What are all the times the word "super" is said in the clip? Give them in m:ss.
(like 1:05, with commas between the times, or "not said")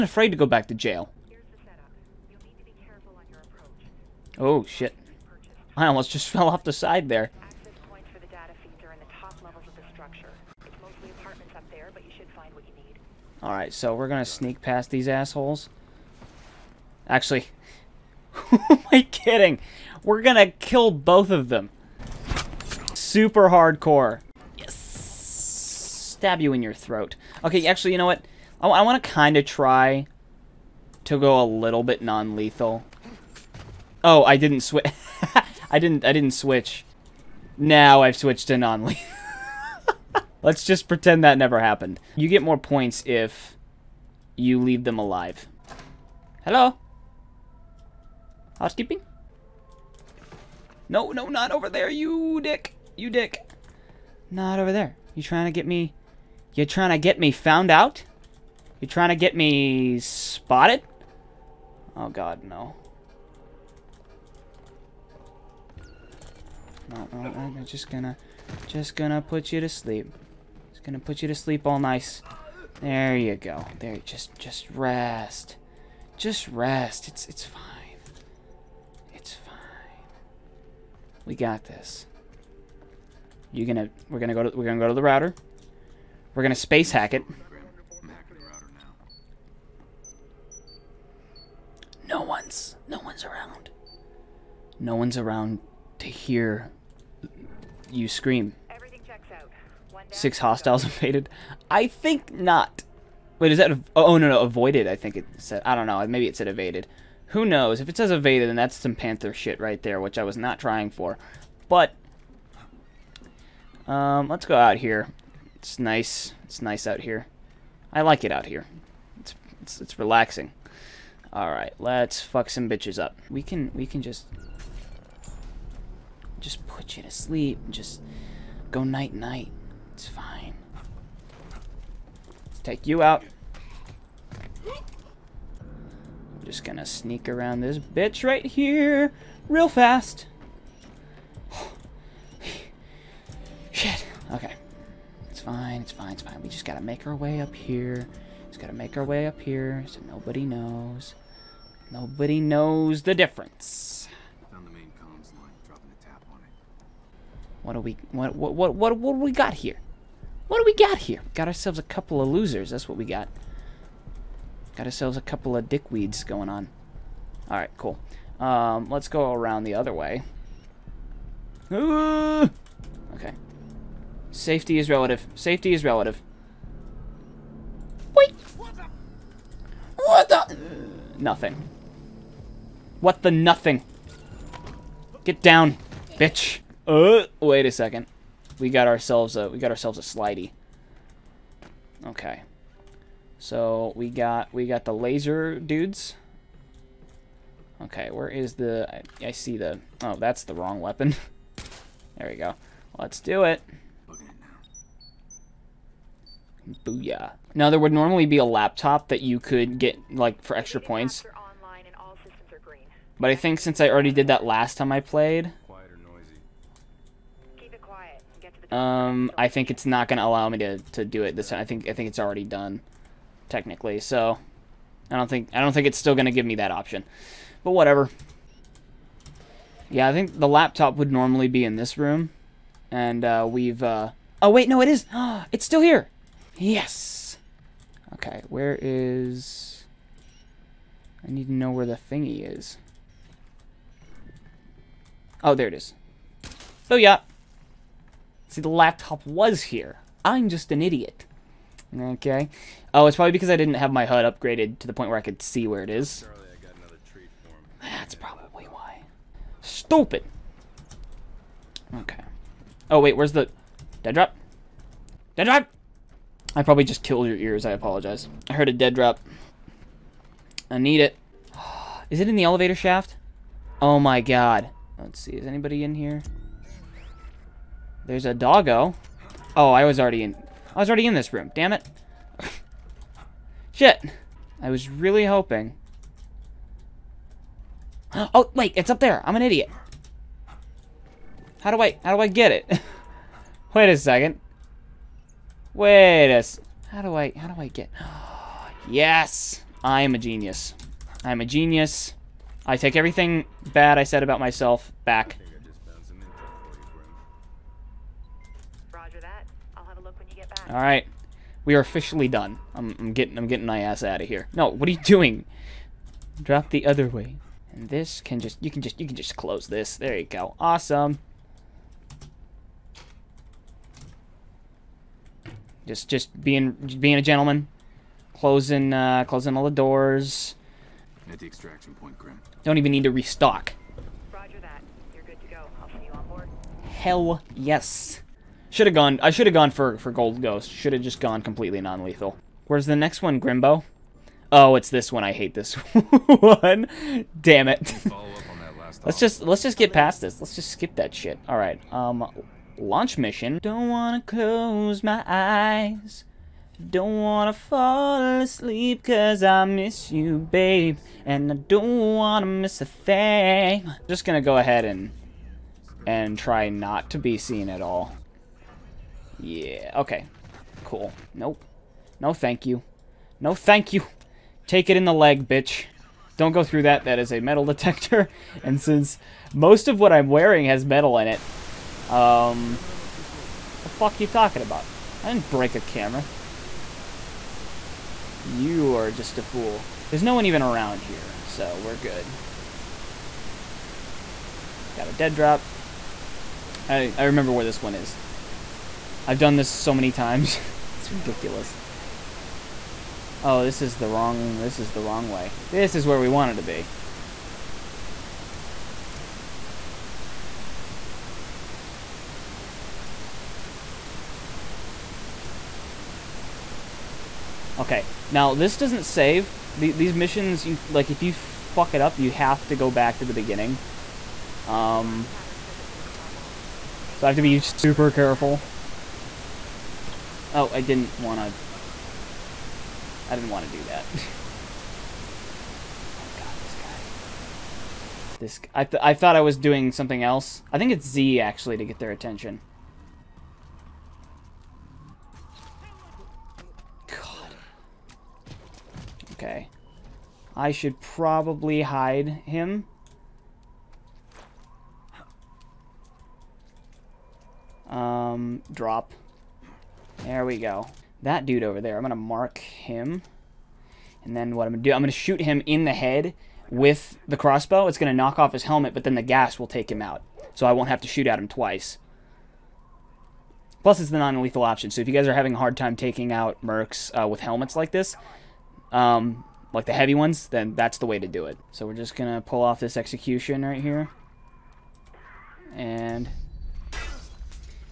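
0:22, 7:07.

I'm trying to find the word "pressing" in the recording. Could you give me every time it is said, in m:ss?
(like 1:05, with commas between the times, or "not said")
not said.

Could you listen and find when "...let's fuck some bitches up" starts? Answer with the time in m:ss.
2:01.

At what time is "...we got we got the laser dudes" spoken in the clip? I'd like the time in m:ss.
3:13.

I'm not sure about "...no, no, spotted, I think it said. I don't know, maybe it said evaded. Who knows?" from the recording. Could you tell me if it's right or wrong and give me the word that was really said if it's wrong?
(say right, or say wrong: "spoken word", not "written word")
wrong: "avoided", not "spotted".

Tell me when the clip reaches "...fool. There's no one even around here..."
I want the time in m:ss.
6:29.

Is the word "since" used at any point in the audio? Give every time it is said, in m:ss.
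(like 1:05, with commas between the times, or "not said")
3:33, 6:18.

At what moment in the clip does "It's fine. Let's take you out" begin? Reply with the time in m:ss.
2:09.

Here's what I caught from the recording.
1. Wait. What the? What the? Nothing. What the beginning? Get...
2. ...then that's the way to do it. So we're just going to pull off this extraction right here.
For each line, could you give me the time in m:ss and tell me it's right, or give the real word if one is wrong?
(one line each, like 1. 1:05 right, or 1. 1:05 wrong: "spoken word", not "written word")
1. 2:58 wrong: "nothing", not "beginning"
2. 8:00 wrong: "execution", not "extraction".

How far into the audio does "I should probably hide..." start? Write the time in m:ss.
7:30.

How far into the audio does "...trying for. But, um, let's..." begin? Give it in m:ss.
1:50.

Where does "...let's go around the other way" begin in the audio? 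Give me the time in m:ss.
2:48.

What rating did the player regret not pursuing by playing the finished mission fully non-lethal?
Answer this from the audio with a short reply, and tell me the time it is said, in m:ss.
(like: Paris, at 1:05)
Gold Ghost, at 5:40.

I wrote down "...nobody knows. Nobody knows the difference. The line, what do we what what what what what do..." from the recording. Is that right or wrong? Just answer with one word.
right.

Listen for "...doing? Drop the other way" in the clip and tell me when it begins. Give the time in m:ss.
5:15.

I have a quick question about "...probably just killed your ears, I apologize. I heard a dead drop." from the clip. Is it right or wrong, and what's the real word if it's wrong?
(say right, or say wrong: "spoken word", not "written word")
right.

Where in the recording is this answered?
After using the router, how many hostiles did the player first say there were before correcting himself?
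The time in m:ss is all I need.
1:40.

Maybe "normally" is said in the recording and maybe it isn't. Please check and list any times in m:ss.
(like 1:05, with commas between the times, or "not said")
3:27, 3:51.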